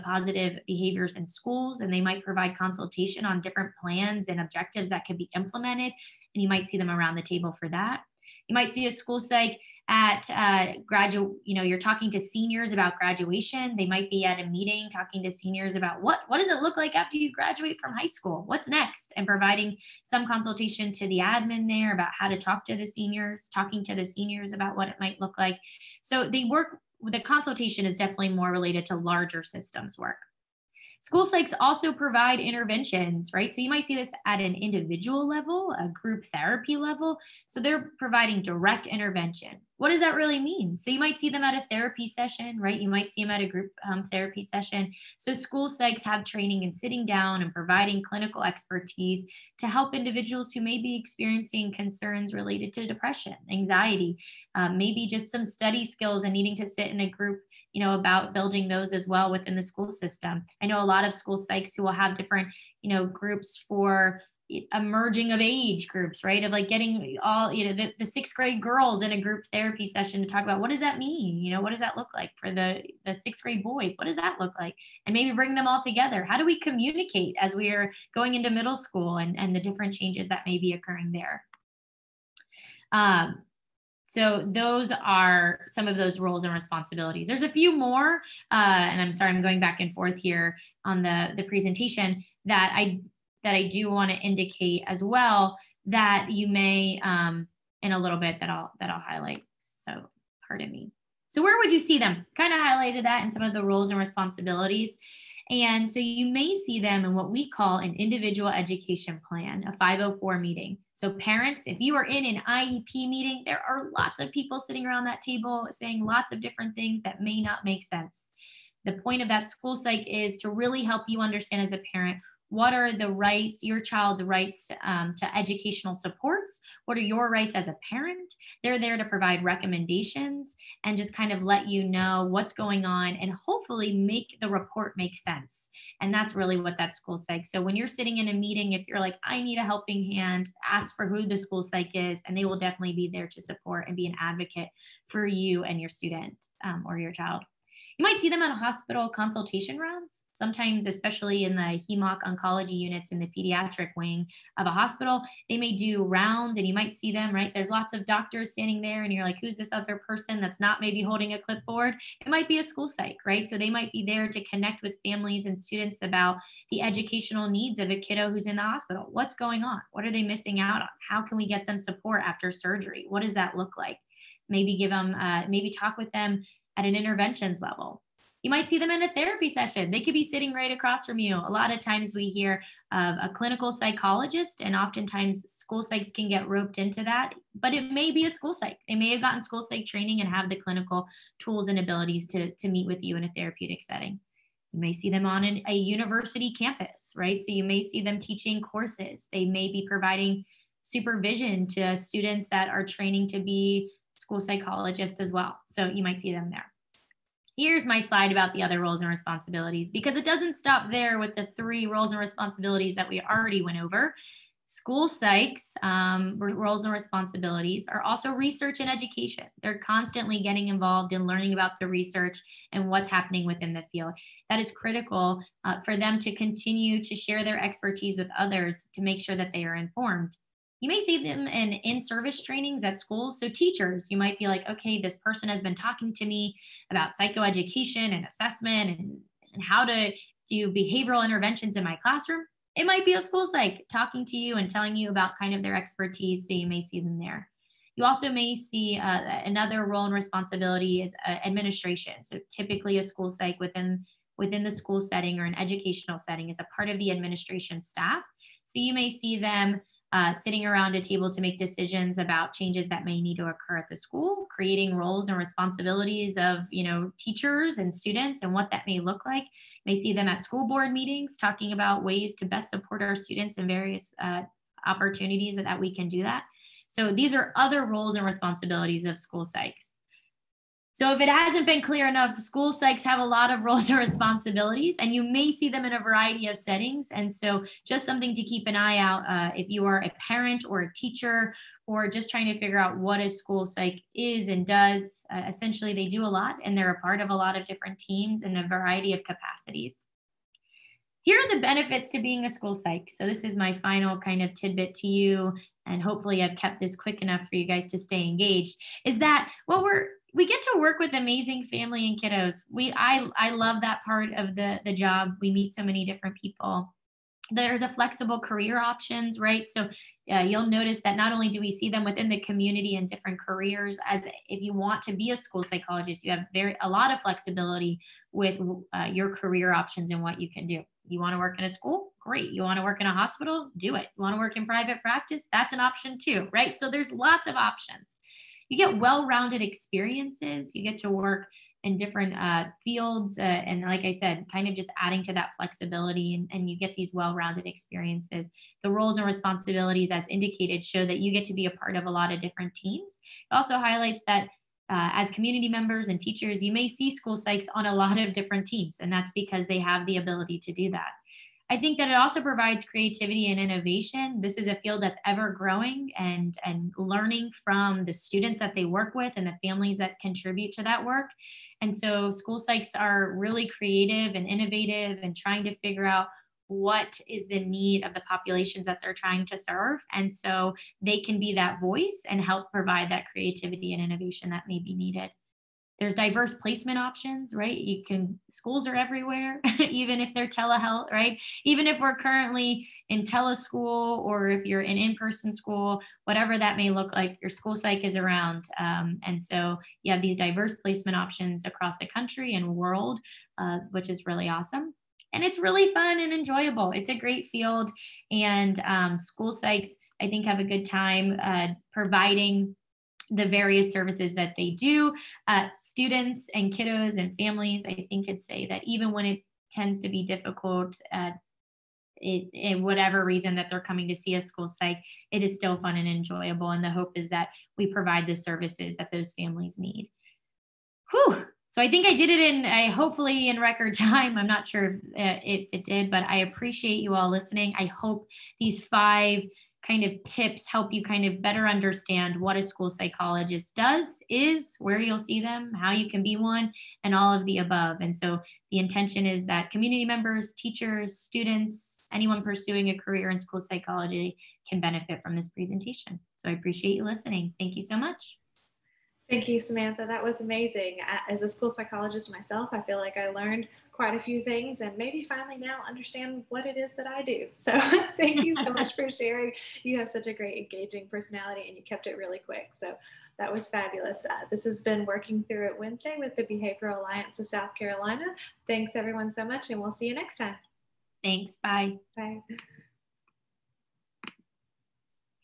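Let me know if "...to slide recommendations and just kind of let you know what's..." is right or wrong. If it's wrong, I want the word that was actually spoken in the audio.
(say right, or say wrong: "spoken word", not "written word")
wrong: "provide", not "slide".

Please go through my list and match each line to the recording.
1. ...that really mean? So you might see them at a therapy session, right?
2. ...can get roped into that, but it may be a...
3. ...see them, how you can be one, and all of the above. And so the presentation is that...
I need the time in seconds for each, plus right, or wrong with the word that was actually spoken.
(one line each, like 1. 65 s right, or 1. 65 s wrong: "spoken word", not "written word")
1. 40 s right
2. 186 s right
3. 445 s wrong: "intention", not "presentation".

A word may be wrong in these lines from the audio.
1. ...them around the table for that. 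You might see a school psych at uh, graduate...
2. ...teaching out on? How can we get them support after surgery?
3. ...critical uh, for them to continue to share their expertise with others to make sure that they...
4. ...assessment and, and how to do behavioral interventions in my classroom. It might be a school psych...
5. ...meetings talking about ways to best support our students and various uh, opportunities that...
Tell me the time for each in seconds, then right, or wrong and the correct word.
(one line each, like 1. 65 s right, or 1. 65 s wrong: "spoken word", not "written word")
1. 6 s right
2. 170 s wrong: "missing", not "teaching"
3. 224 s right
4. 238 s right
5. 270 s right.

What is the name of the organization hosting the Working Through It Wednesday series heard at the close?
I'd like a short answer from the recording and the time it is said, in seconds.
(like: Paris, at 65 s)
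Behavioral Alliance of South Carolina, at 476 s.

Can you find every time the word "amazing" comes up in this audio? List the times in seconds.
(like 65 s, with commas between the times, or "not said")
311 s, 460 s.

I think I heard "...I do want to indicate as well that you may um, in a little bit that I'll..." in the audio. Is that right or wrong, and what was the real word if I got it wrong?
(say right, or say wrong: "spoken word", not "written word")
right.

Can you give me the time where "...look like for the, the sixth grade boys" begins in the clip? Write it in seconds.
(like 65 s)
71 s.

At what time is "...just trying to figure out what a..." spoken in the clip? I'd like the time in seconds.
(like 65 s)
292 s.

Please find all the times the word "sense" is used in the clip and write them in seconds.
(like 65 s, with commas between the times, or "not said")
117 s, 135 s.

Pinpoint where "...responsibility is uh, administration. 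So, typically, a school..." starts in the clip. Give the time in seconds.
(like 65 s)
250 s.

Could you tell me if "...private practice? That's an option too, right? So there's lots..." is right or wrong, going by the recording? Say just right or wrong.
right.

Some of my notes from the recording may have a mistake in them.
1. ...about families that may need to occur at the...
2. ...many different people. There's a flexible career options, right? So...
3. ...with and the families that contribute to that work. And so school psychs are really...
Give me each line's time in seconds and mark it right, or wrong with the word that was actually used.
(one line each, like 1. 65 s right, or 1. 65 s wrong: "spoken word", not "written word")
1. 262 s wrong: "changes", not "families"
2. 315 s right
3. 369 s right.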